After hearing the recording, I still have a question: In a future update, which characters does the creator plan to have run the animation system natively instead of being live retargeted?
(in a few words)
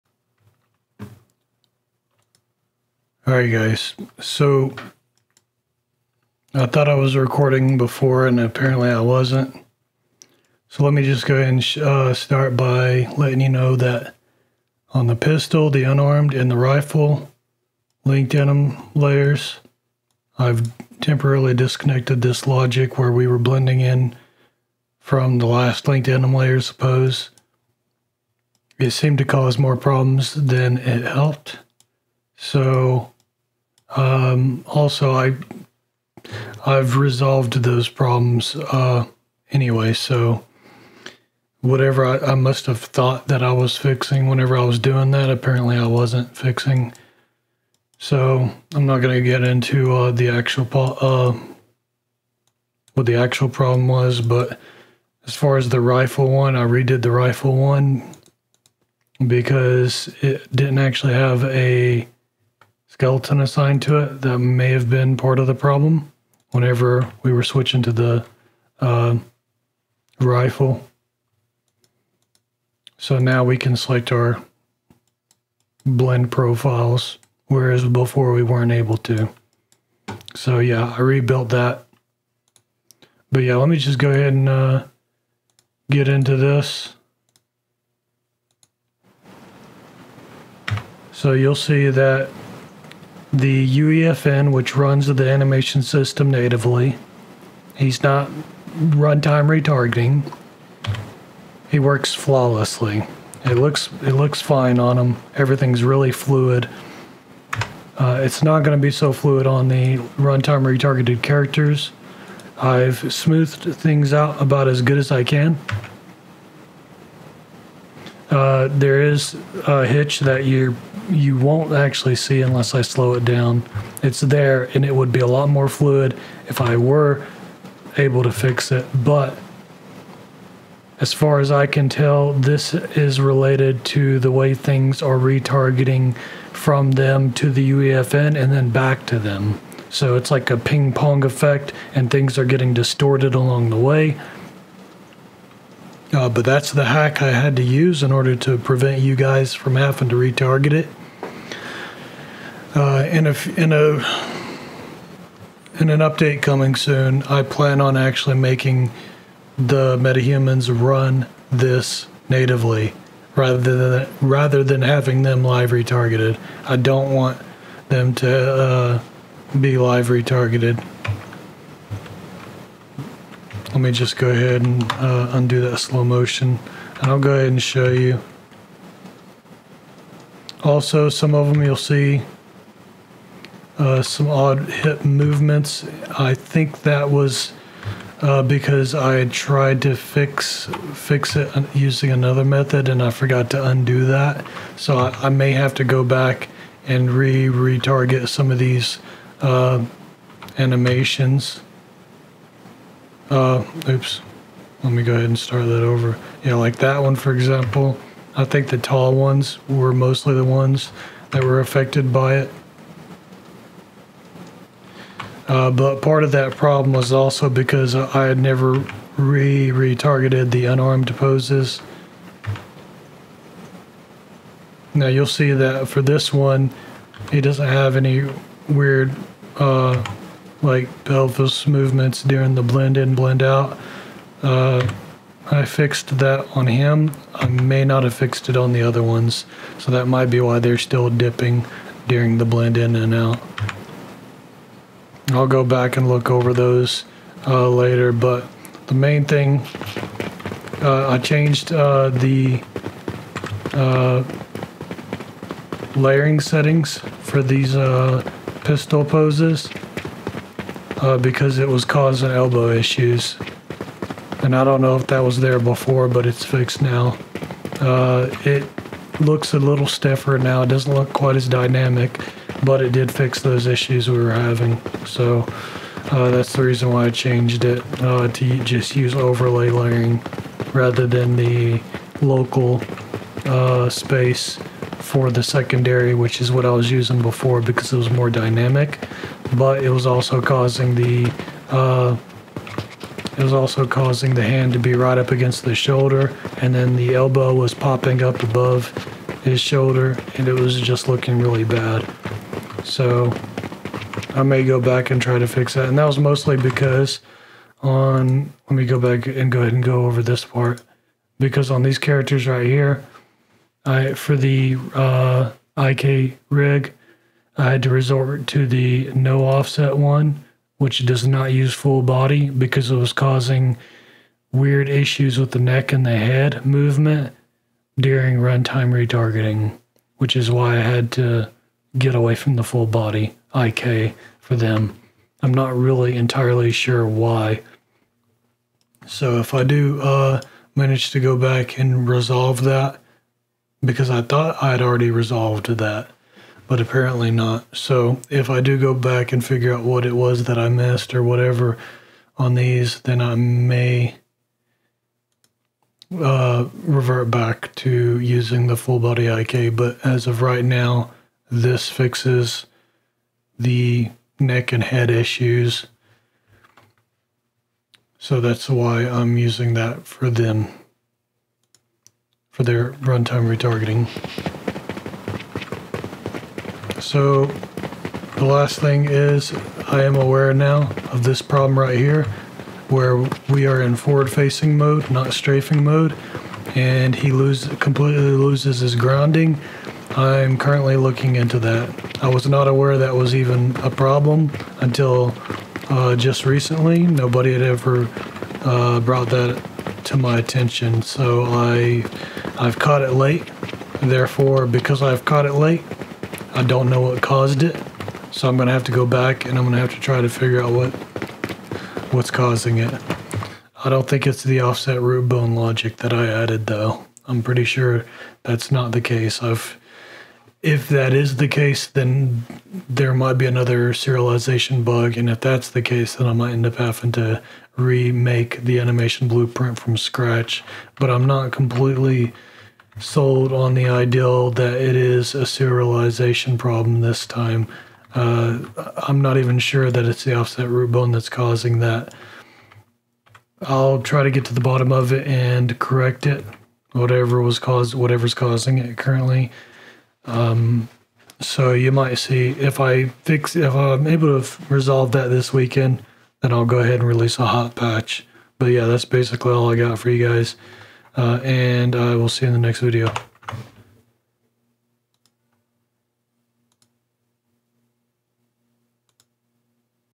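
Metahumans.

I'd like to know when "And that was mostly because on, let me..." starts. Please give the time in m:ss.
5:05.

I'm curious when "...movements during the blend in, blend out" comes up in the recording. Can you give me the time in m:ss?
3:51.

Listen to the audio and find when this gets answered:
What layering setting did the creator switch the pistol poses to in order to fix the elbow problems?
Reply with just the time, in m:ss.
4:39.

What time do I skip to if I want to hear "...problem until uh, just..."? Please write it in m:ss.
6:33.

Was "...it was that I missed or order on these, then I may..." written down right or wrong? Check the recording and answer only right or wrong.
wrong.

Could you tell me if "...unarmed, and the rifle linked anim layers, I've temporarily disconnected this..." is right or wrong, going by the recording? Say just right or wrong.
right.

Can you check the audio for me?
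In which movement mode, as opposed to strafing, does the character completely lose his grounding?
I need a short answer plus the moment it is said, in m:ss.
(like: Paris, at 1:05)
Forward facing mode, at 6:23.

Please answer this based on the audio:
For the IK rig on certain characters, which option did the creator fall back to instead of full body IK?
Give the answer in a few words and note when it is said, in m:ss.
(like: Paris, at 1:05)
No offset, at 5:19.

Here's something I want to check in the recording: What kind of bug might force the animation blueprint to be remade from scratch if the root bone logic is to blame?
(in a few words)
Serialization bug.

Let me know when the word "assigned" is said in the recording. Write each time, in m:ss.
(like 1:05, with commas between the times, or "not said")
1:03.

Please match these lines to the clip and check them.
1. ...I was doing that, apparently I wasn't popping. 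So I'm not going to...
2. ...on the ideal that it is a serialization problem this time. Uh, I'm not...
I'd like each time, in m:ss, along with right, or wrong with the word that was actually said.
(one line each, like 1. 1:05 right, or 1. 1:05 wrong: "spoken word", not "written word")
1. 0:44 wrong: "fixing", not "popping"
2. 7:13 right.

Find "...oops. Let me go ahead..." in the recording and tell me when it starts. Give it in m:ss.
3:23.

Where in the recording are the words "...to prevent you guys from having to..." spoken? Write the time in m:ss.
2:28.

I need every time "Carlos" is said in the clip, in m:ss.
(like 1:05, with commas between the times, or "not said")
not said.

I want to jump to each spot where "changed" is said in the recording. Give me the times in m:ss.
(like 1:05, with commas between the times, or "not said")
4:11, 4:37.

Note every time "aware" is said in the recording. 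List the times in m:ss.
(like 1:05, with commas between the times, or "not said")
6:20, 6:32.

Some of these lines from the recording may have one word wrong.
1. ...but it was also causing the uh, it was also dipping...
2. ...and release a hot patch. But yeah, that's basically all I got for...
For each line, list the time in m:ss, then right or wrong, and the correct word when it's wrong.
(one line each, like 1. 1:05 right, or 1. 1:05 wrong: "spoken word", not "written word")
1. 4:49 wrong: "causing", not "dipping"
2. 7:36 right.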